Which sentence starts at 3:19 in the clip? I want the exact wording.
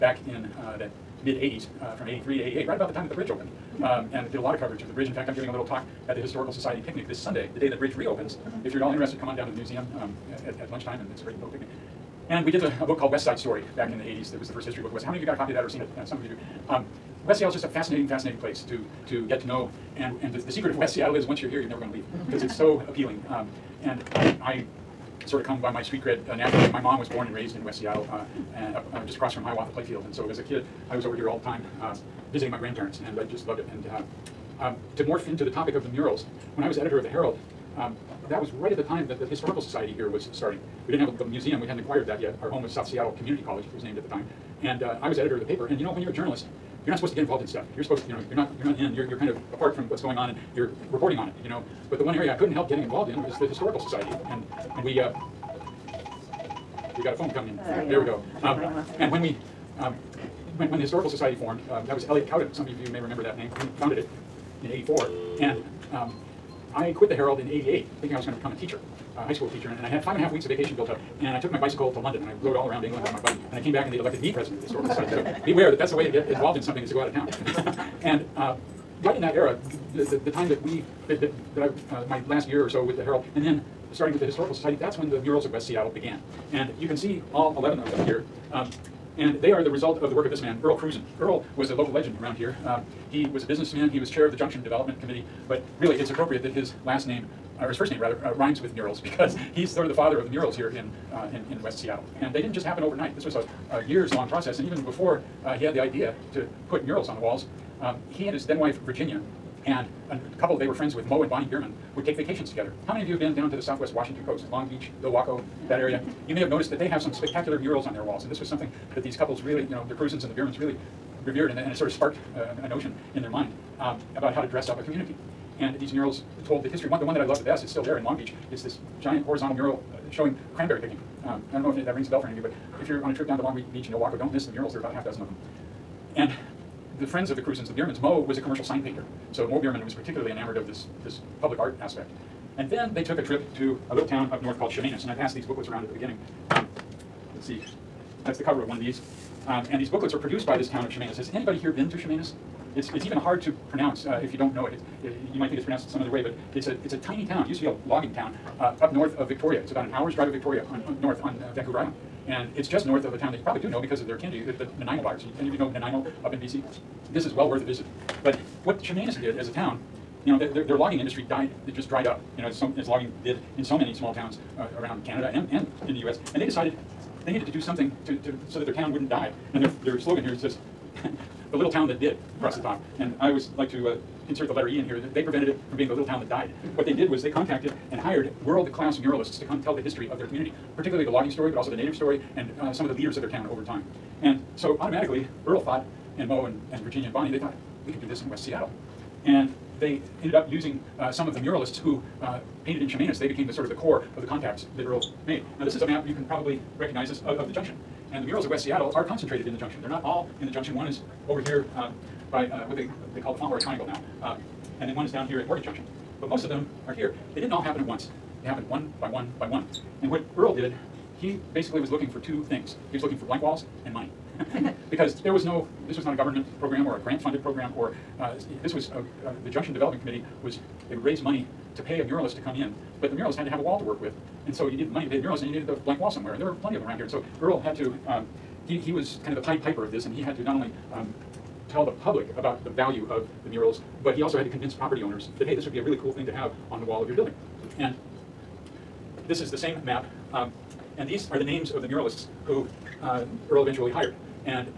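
And they ended up using uh, some of the muralists who uh, painted in Chemainus.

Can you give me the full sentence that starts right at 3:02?
And I always like to uh, insert the letter E in here.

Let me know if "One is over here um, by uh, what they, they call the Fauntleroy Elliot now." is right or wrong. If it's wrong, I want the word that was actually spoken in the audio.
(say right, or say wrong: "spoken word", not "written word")
wrong: "Triangle", not "Elliot".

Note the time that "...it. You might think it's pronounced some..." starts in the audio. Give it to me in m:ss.
2:35.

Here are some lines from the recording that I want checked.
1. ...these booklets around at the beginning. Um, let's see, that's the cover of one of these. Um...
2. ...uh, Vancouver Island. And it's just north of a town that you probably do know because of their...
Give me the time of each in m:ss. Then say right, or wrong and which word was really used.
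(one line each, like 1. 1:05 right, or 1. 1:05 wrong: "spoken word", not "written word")
1. 2:25 right
2. 2:41 right.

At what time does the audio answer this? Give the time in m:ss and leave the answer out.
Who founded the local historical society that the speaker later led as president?
1:02.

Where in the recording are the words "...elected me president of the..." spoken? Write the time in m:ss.
1:13.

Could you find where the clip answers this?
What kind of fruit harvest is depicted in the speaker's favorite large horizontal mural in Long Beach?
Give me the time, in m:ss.
2:10.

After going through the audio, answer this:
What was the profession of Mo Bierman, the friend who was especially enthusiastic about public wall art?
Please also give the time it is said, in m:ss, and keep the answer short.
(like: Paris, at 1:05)
Commercial sign painter, at 2:18.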